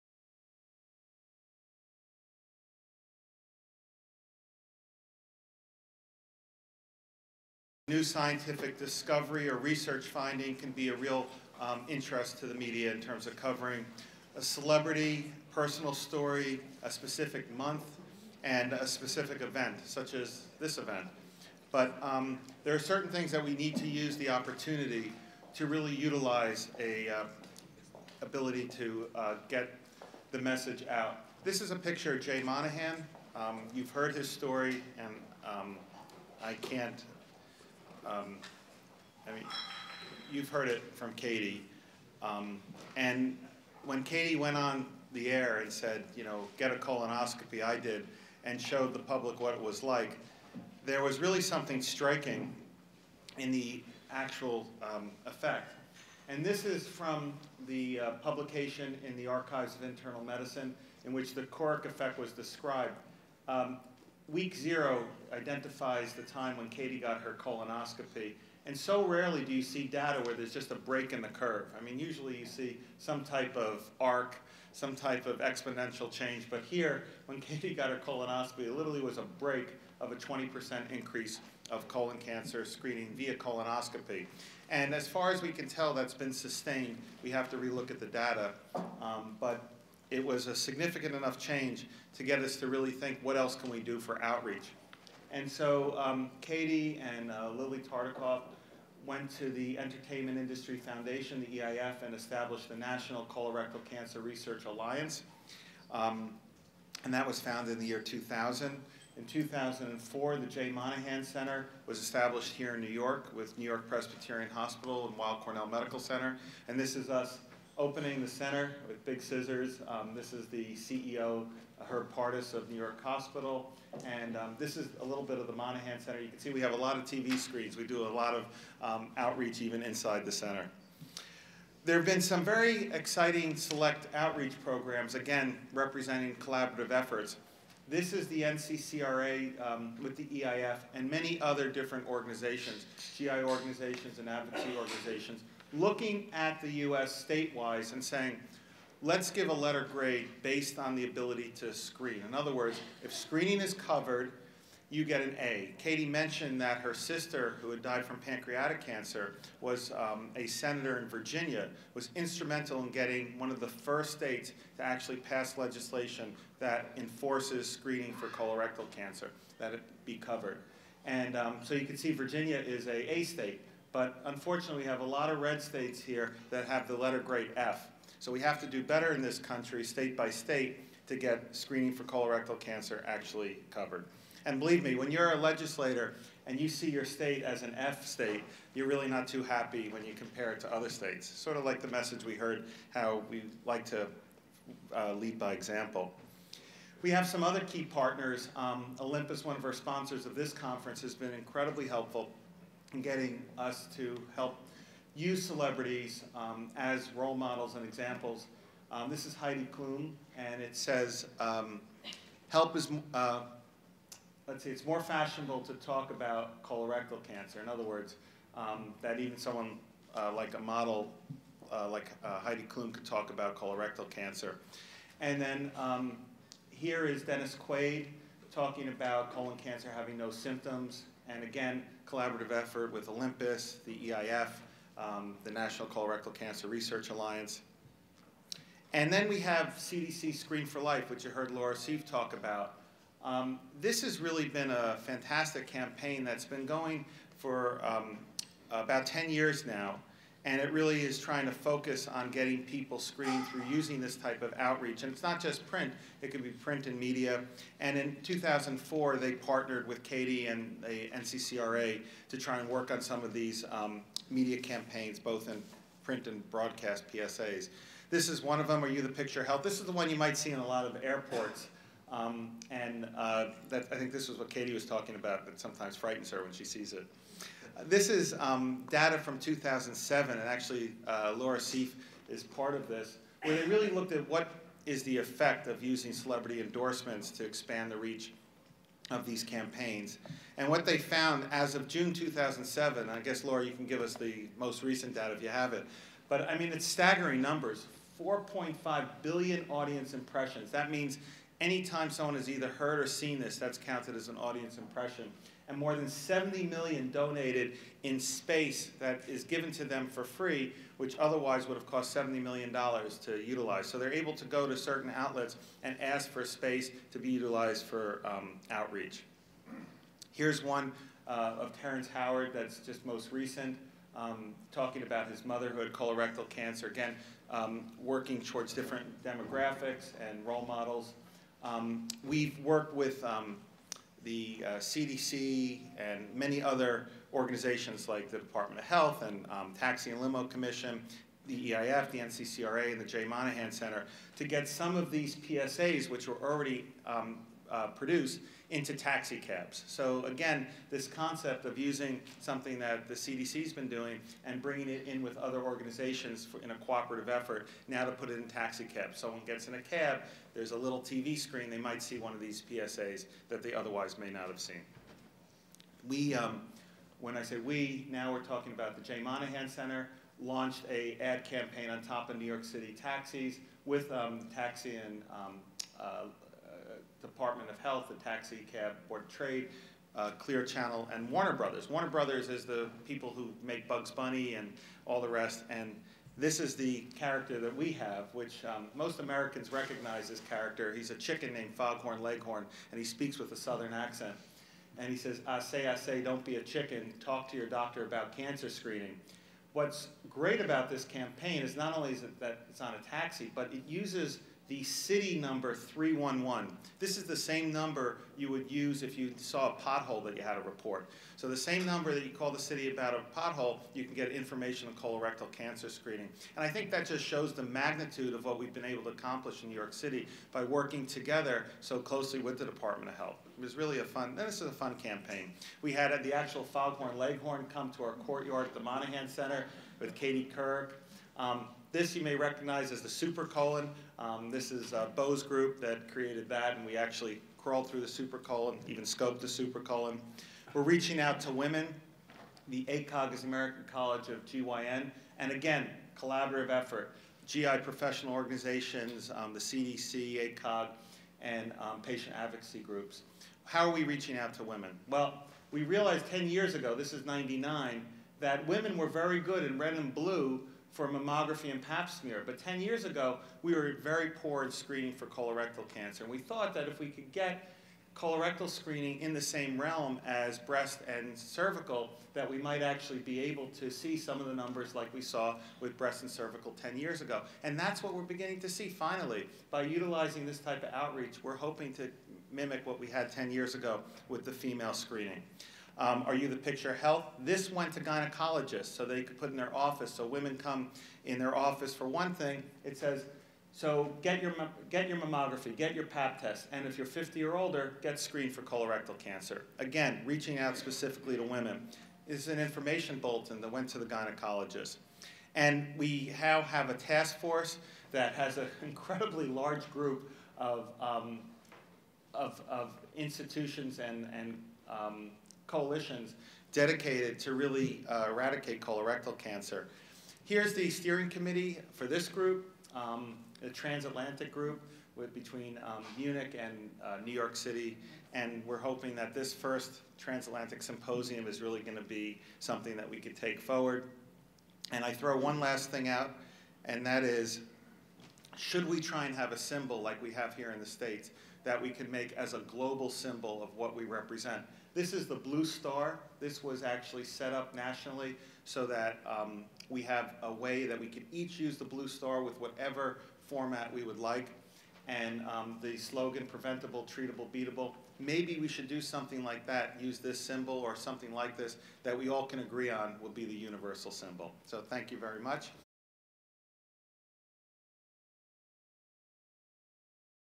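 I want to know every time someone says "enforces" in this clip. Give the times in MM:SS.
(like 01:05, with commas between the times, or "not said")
02:46.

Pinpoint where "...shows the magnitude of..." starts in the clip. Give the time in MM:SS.
06:57.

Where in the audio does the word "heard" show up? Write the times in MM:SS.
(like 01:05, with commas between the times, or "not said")
00:33, 00:40, 03:12, 04:01, 05:02.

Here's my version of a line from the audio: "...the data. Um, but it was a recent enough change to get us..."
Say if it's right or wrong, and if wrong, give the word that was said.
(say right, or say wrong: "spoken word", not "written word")
wrong: "significant", not "recent".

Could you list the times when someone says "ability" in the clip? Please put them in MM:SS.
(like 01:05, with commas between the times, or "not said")
00:28, 02:31.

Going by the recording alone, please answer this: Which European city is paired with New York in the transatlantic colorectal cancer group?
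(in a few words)
Munich.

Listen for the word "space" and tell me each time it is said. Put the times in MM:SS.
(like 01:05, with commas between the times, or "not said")
05:08, 05:16.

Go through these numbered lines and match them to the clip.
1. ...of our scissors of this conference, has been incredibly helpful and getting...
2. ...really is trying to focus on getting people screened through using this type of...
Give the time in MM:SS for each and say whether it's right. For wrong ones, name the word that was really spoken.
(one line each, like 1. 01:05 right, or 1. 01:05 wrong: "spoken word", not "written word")
1. 03:19 wrong: "sponsors", not "scissors"
2. 04:10 right.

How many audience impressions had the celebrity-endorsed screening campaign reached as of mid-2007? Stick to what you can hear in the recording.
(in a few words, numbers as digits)
4.5 billion.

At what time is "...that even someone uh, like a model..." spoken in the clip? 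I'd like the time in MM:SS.
03:39.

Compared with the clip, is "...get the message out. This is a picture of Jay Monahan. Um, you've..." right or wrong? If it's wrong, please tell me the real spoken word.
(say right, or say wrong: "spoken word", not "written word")
right.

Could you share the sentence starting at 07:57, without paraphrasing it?
And that's what we're beginning to see finally.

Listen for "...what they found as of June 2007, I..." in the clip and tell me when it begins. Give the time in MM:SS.
04:50.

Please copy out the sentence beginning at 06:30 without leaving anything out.
He's a chicken named Foghorn Leghorn, and he speaks with a southern accent.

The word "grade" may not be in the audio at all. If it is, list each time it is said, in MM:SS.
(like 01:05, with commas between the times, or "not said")
02:29, 02:57.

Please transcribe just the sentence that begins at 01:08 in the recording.
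And so rarely do you see data where there's just a break in the curve.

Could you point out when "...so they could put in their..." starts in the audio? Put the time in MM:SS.
08:08.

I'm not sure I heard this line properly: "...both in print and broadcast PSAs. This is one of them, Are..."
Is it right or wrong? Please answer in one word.
right.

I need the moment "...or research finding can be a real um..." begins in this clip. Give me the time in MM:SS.
00:09.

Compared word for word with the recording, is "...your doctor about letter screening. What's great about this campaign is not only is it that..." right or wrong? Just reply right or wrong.
wrong.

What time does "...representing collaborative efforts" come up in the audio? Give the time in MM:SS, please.
02:15.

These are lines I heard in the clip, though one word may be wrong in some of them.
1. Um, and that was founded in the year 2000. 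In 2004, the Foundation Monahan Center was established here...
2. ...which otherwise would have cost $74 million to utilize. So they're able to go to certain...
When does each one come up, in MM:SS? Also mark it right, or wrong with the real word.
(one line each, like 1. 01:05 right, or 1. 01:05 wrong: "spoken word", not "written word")
1. 01:45 wrong: "Jay", not "Foundation"
2. 05:10 wrong: "70", not "74".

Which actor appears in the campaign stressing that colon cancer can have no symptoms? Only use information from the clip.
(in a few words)
Dennis Quaid.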